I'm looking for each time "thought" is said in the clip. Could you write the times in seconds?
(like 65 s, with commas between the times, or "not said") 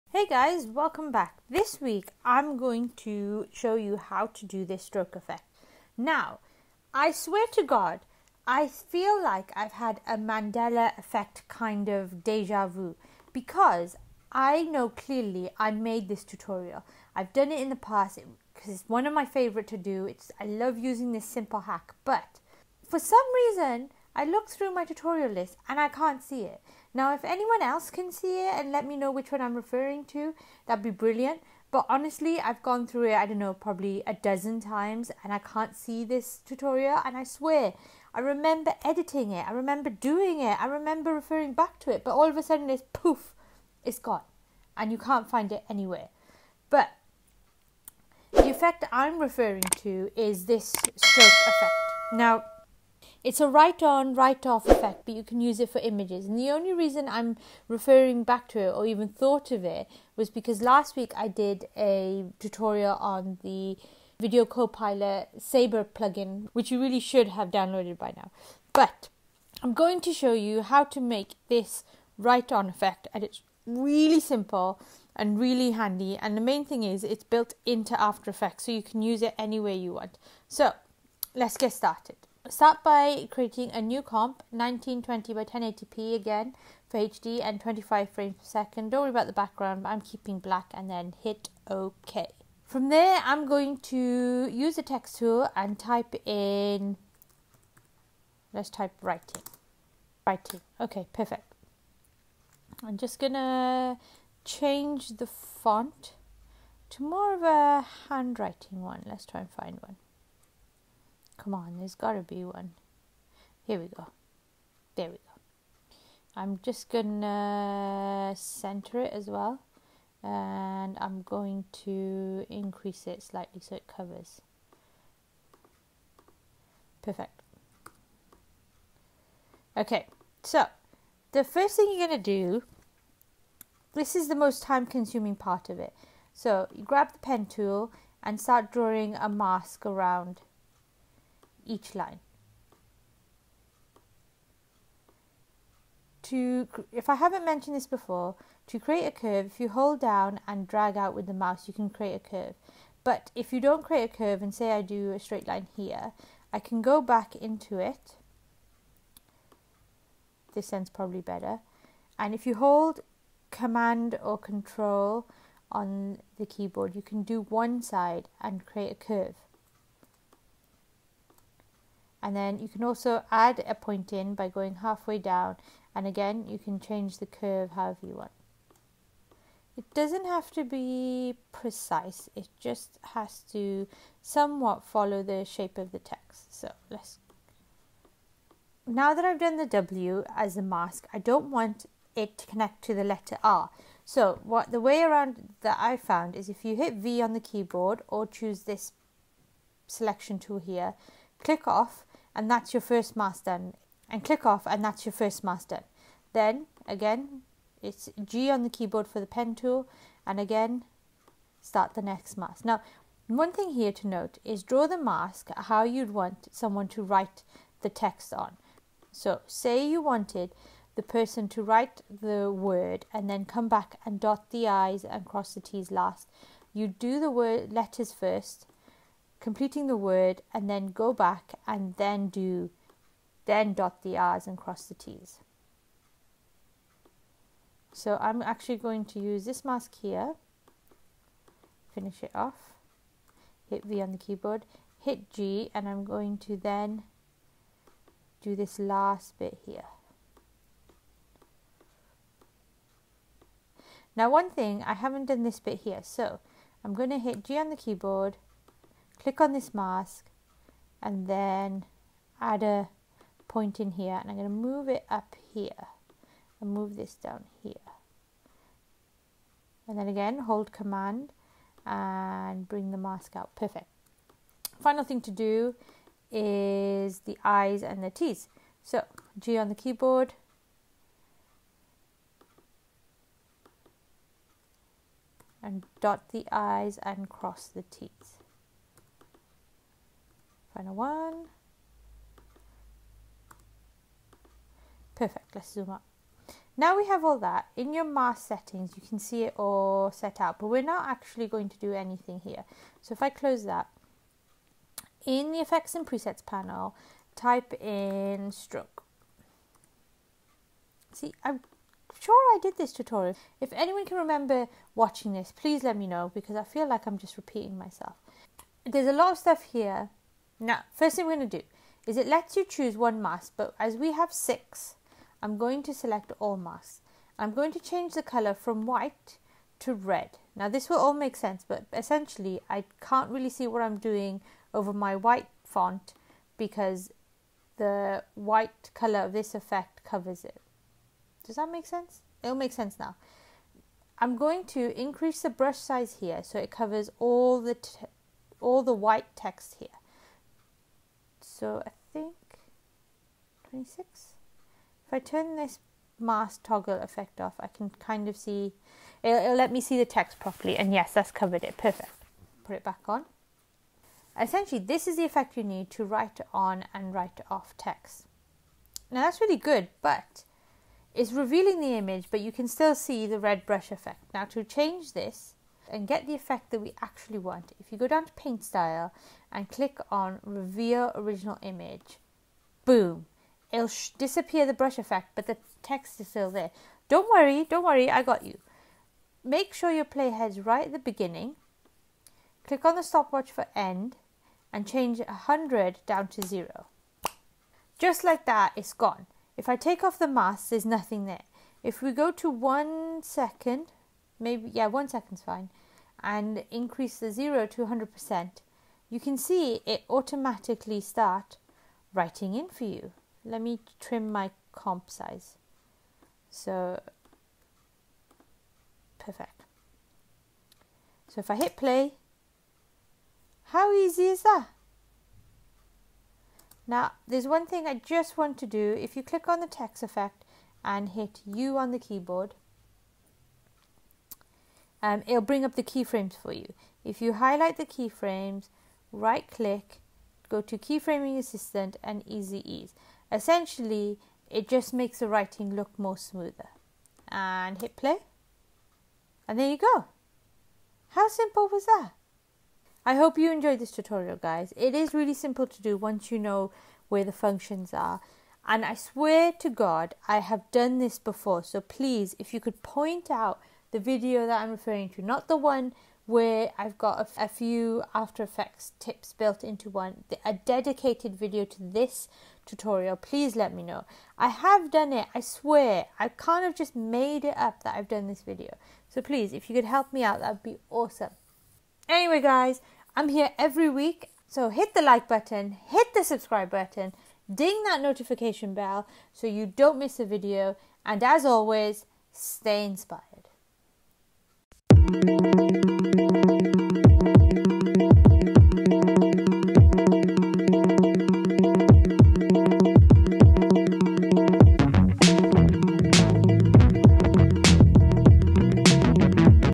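59 s.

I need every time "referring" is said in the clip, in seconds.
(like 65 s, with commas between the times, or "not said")
29 s, 41 s, 49 s, 57 s, 464 s.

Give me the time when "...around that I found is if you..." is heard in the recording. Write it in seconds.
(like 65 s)
195 s.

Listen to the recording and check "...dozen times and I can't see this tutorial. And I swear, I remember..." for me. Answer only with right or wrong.
right.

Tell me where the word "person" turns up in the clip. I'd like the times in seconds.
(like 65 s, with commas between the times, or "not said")
221 s.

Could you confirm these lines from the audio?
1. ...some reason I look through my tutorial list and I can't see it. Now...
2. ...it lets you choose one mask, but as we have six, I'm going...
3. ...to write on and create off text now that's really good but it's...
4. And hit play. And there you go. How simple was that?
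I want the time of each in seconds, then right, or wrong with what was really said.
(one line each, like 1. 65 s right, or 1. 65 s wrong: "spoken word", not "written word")
1. 22 s right
2. 322 s right
3. 365 s wrong: "write", not "create"
4. 447 s right.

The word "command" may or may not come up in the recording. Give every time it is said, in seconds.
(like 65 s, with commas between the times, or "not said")
163 s, 270 s.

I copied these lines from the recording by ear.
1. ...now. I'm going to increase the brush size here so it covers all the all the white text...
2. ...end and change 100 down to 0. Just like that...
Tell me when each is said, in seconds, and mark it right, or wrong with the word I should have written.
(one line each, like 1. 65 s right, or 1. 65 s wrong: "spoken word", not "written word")
1. 342 s right
2. 393 s right.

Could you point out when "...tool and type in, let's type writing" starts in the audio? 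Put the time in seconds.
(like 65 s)
95 s.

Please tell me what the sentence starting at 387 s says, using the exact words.
Don't worry, don't worry, I got you.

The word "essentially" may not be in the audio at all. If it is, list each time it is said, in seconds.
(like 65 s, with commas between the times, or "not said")
331 s, 364 s, 443 s.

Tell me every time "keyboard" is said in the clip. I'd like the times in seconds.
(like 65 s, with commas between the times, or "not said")
166 s, 197 s, 208 s, 244 s, 257 s, 279 s, 431 s.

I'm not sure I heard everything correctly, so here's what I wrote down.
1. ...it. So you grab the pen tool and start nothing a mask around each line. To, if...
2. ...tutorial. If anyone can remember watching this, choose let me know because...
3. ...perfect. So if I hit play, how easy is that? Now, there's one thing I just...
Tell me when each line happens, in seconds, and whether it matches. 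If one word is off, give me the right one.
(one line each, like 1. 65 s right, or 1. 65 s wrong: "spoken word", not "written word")
1. 135 s wrong: "drawing", not "nothing"
2. 312 s wrong: "please", not "choose"
3. 419 s right.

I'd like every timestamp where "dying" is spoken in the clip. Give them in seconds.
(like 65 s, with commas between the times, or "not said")
not said.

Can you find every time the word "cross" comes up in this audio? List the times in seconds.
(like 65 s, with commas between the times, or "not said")
225 s, 234 s, 287 s.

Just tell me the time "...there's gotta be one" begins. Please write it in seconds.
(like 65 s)
111 s.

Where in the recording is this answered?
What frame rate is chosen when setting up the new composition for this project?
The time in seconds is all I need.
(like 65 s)
87 s.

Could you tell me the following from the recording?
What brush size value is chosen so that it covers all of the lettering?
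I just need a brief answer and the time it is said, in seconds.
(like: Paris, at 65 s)
26, at 353 s.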